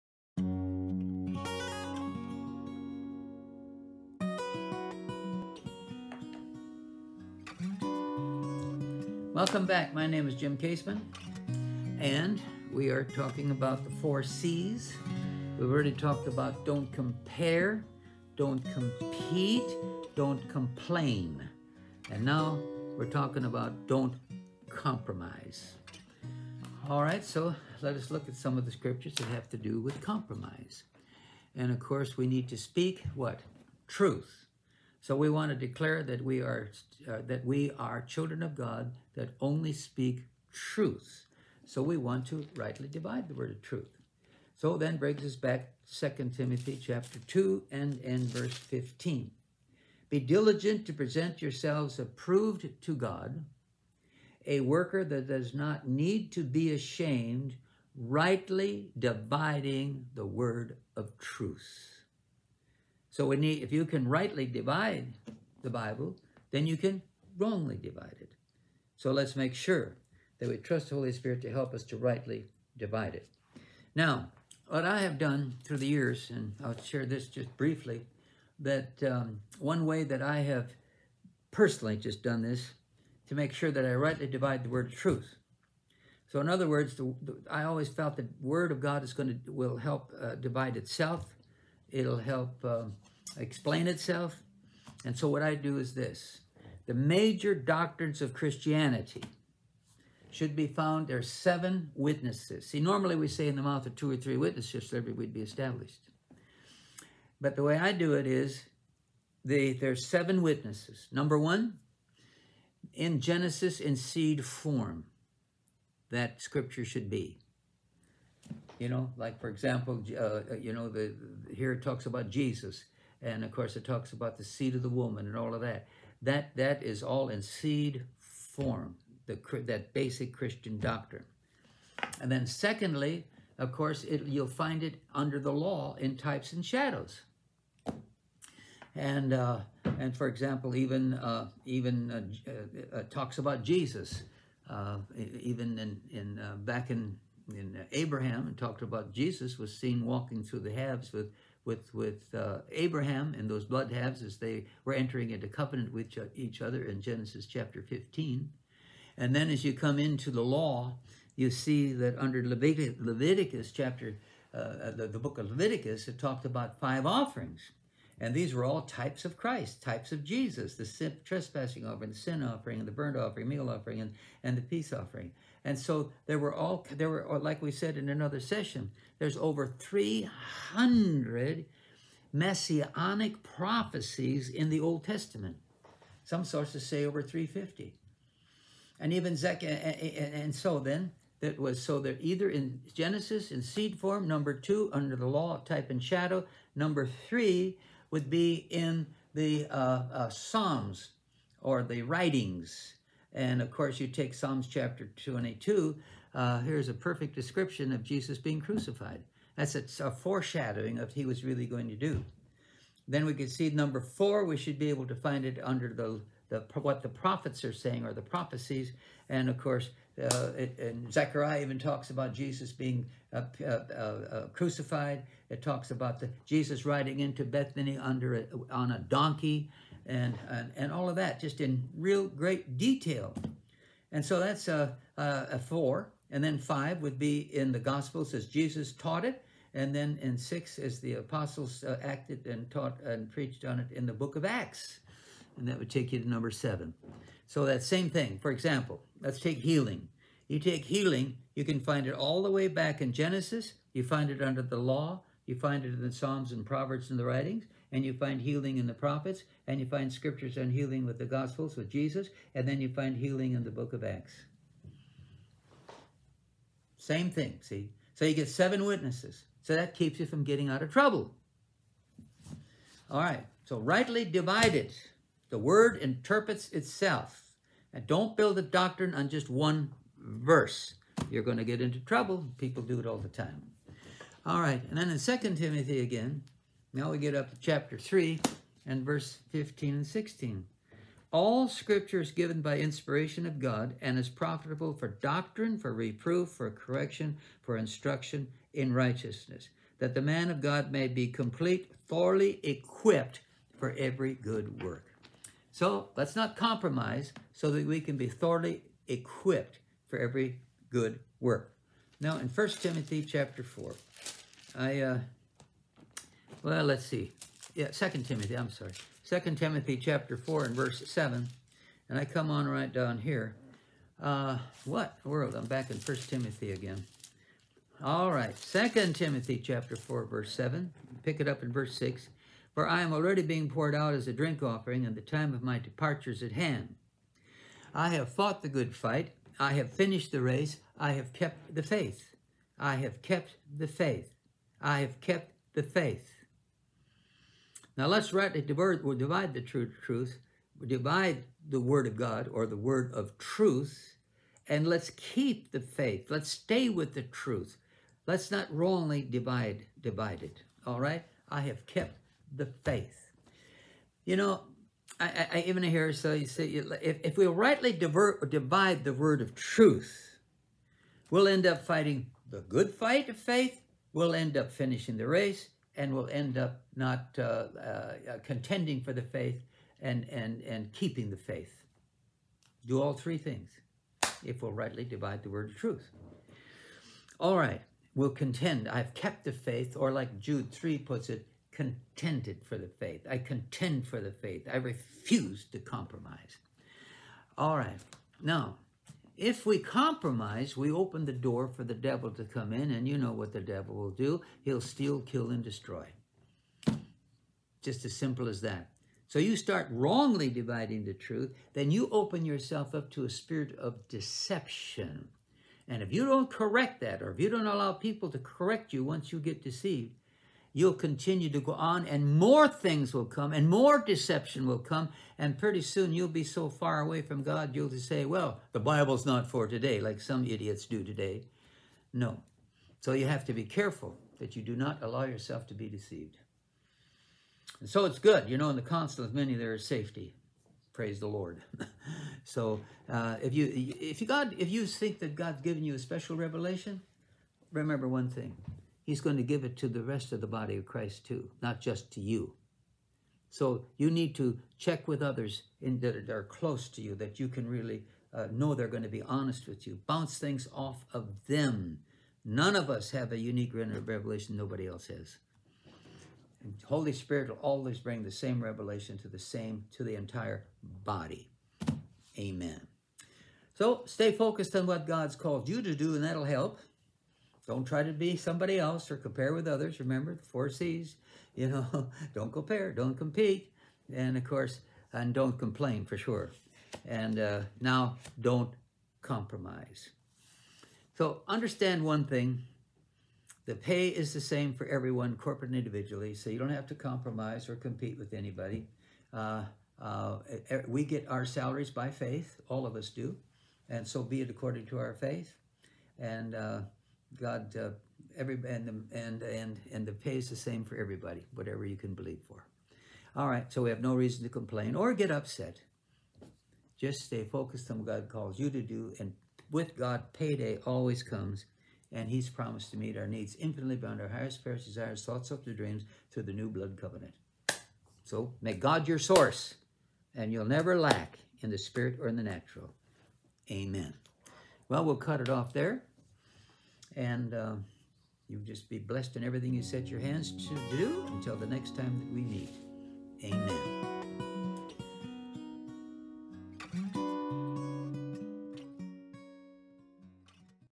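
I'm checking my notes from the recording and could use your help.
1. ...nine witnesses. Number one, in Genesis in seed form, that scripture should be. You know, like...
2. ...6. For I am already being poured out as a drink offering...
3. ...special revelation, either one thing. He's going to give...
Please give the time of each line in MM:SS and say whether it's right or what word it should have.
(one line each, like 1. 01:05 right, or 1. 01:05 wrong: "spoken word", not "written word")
1. 01:49 wrong: "seven", not "nine"
2. 05:31 right
3. 07:25 wrong: "remember", not "either".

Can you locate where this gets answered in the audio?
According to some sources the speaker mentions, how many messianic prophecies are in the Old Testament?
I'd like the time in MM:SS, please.
03:07.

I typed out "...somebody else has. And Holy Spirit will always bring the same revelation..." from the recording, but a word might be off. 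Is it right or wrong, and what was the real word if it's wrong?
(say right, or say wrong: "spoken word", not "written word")
wrong: "nobody", not "somebody".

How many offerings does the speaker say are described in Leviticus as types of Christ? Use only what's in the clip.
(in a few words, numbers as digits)
5.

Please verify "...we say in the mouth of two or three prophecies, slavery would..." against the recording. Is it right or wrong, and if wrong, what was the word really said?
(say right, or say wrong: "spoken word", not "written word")
wrong: "witnesses", not "prophecies".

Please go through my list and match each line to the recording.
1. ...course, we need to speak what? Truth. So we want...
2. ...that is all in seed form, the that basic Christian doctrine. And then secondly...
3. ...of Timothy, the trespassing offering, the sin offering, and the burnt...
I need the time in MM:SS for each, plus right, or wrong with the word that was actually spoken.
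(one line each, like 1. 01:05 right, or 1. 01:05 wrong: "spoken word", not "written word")
1. 00:31 right
2. 02:06 right
3. 02:50 wrong: "Jesus", not "Timothy".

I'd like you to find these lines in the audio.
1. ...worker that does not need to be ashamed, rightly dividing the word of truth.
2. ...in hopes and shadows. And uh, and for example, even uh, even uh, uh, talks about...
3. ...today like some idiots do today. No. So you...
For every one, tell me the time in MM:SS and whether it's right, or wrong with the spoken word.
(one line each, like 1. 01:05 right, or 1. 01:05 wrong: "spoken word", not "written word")
1. 00:54 right
2. 02:15 wrong: "types", not "hopes"
3. 07:09 right.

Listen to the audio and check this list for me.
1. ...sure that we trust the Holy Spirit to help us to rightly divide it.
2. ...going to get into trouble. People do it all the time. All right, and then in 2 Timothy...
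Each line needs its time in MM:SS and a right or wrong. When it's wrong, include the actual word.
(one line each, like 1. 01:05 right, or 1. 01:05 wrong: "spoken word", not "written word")
1. 01:09 right
2. 04:41 right.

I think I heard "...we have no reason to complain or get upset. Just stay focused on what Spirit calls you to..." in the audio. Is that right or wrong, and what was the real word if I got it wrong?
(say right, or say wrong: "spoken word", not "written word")
wrong: "God", not "Spirit".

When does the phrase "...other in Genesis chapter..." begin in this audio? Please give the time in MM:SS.
02:36.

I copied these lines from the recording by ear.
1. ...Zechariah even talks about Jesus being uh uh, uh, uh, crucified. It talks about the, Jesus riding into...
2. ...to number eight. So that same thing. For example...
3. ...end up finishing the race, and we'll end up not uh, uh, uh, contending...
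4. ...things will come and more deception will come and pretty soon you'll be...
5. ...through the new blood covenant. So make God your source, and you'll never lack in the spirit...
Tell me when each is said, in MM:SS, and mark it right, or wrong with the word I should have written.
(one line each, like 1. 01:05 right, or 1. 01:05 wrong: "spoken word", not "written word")
1. 03:41 right
2. 04:06 wrong: "seven", not "eight"
3. 06:14 right
4. 07:02 right
5. 08:46 right.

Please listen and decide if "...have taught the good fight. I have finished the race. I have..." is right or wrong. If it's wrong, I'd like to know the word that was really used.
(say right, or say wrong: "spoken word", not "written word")
wrong: "fought", not "taught".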